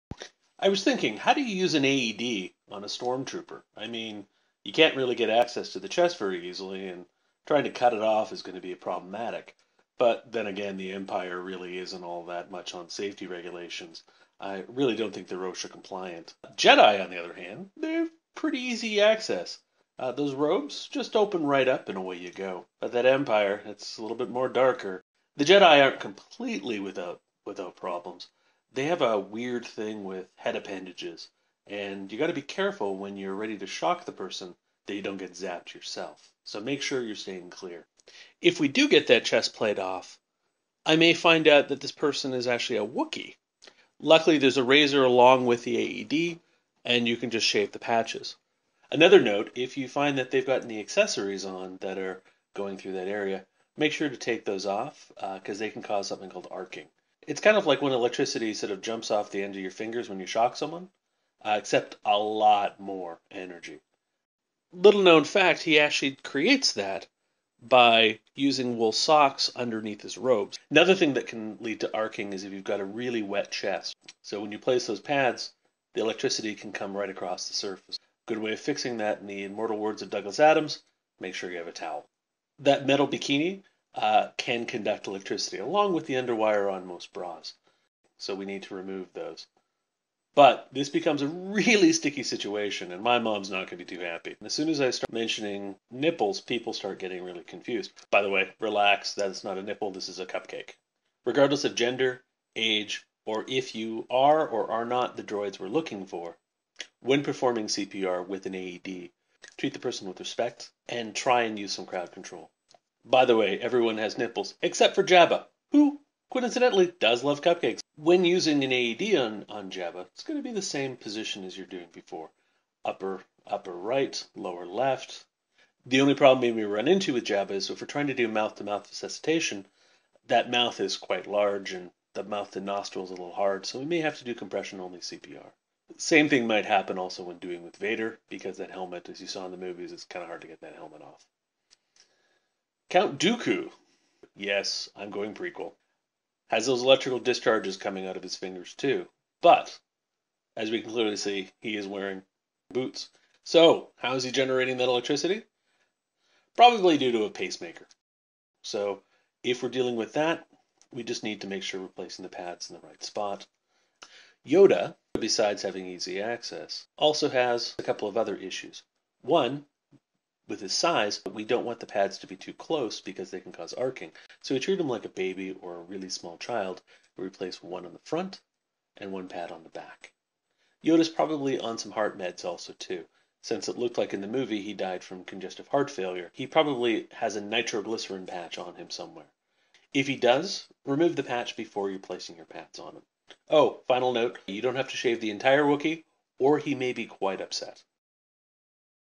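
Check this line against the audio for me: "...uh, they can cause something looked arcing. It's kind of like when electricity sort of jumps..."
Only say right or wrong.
wrong.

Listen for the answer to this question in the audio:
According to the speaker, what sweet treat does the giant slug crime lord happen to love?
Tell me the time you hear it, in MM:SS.
01:57.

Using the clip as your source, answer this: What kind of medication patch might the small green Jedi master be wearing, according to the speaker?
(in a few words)
nitroglycerin patch.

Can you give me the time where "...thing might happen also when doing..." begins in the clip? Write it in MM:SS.
02:16.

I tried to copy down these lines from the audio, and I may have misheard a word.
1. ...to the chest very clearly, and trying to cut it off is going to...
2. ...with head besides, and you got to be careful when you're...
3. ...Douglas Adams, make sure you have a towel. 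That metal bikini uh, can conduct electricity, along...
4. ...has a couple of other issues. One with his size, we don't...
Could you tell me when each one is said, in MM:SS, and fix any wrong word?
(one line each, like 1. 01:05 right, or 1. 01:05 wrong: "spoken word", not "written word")
1. 00:05 wrong: "easily", not "clearly"
2. 00:30 wrong: "appendages", not "besides"
3. 01:20 right
4. 02:47 right.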